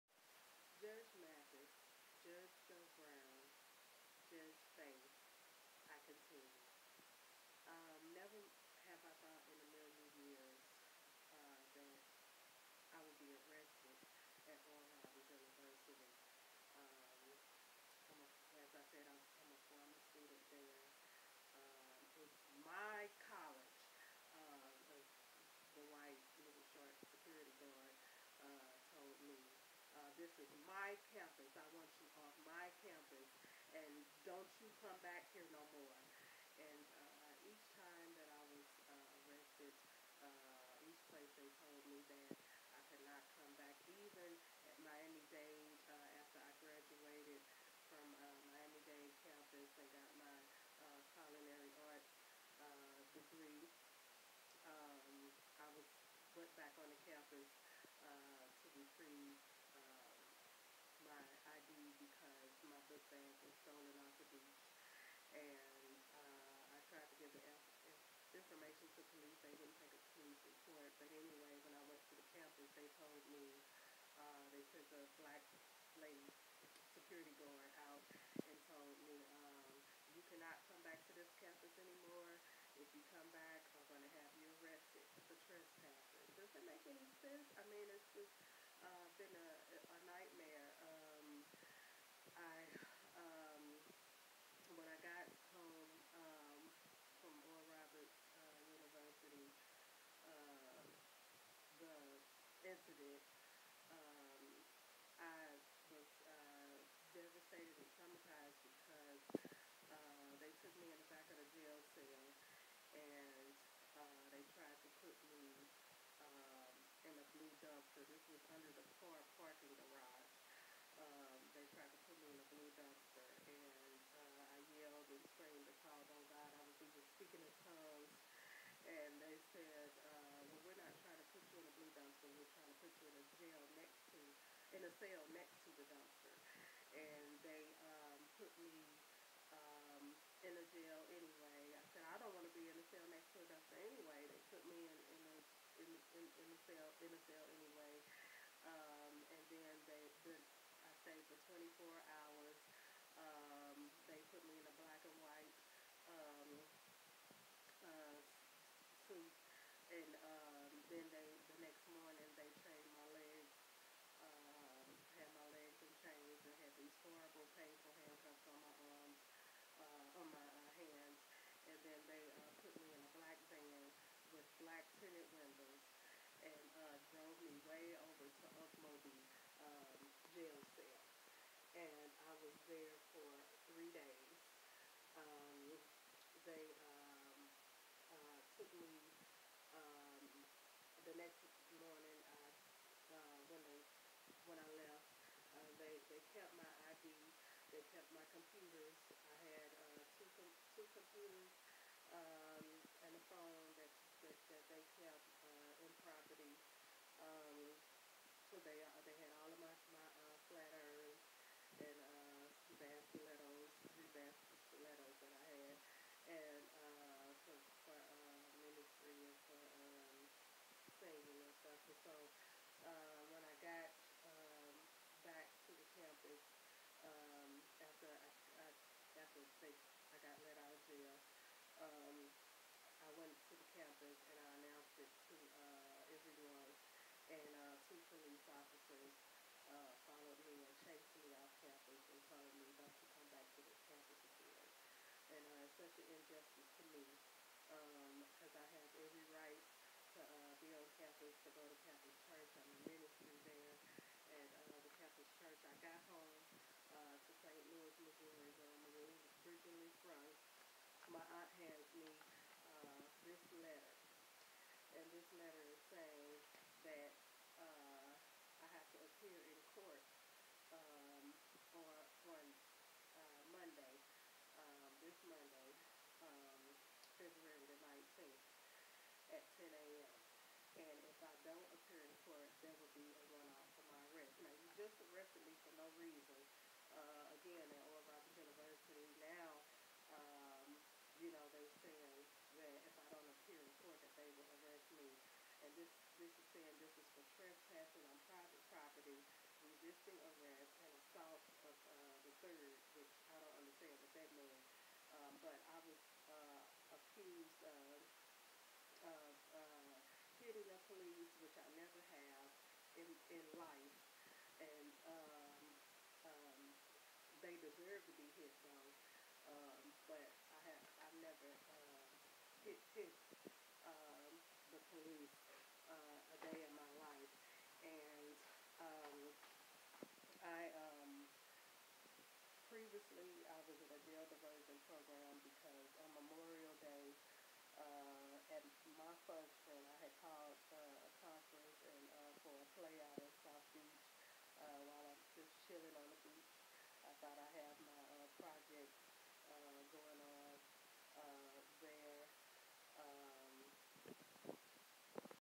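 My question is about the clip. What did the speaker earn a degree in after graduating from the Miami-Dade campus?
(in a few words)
Culinary arts.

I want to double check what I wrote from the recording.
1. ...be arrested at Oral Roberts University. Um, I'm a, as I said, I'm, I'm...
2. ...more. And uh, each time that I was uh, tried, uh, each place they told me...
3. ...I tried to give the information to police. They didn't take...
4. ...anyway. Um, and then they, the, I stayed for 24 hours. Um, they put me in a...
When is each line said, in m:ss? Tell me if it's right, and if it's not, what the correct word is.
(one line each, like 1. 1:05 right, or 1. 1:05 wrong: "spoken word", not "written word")
1. 0:13 right
2. 0:35 wrong: "arrested", not "tried"
3. 1:06 right
4. 2:27 right.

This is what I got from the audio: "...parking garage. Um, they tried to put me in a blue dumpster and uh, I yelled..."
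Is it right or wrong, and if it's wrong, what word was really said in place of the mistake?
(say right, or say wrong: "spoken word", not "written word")
right.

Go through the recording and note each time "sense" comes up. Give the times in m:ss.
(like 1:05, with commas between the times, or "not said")
1:27.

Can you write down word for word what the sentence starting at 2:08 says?
And they said, uh, well, we're not trying to put you in a blue dumpster.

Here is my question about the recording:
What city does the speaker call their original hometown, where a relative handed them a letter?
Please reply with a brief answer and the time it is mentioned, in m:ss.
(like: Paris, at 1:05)
St. Louis, Missouri, at 4:17.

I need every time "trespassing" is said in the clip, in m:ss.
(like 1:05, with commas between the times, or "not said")
1:25, 4:57.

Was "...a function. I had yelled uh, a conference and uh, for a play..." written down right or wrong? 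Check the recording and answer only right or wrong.
wrong.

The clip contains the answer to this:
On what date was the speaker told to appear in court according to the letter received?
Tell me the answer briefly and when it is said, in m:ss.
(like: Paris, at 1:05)
February 19, at 4:37.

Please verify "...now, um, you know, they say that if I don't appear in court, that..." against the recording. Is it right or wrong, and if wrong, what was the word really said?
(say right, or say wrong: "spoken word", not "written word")
right.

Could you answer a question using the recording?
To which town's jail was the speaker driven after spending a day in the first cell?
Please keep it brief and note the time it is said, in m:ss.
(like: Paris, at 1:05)
Okmulgee, at 2:58.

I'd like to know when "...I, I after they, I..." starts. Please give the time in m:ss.
3:48.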